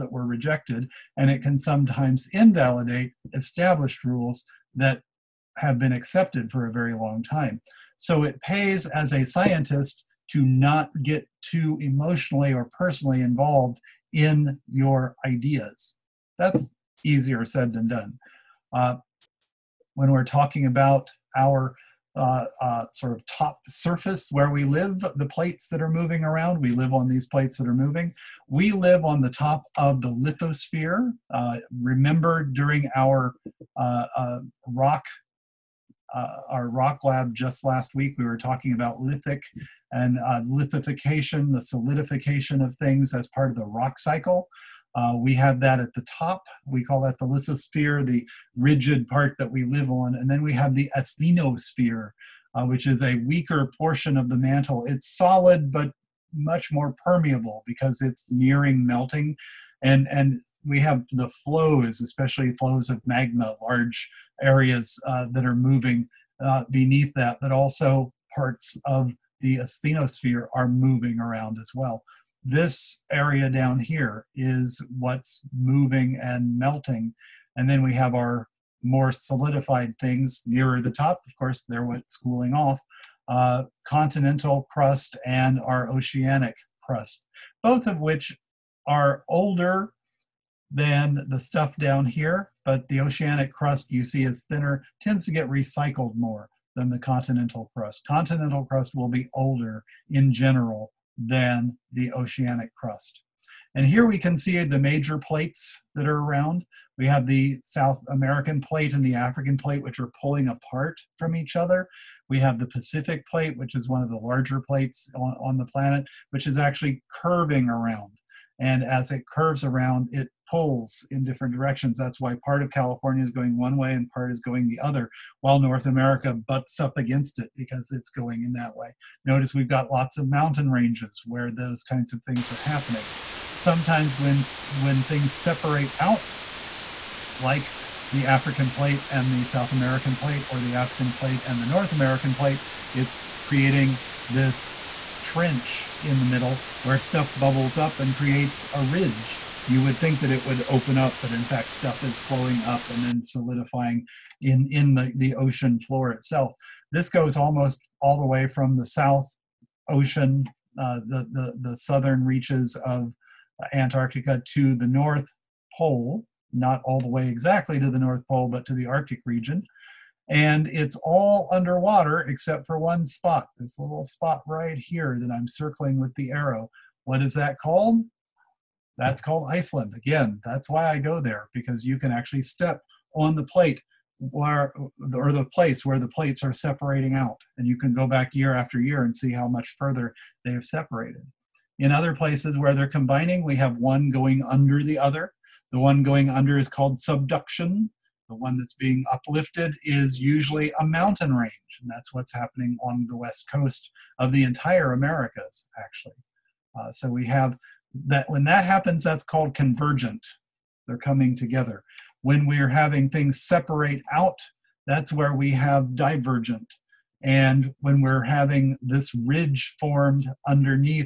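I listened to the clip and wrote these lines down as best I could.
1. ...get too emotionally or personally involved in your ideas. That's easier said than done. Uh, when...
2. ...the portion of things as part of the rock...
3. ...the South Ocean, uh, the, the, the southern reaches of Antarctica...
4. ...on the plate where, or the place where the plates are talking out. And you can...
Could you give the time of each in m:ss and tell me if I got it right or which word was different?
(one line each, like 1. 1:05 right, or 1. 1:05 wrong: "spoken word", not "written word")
1. 0:11 right
2. 0:41 wrong: "solidification", not "portion"
3. 2:38 right
4. 3:03 wrong: "separating", not "talking".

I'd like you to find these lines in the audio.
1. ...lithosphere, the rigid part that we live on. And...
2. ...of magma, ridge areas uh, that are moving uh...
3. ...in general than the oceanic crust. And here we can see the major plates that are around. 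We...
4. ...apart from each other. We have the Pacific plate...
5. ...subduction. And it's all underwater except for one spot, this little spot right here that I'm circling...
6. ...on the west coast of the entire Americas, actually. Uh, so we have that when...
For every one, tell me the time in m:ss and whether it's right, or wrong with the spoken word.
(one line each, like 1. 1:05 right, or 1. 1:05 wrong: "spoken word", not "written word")
1. 0:47 right
2. 1:02 wrong: "large", not "ridge"
3. 1:40 right
4. 1:50 right
5. 2:49 wrong: "region", not "subduction"
6. 3:22 right.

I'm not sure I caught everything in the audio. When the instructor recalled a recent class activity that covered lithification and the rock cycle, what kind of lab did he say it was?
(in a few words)
Rock lab.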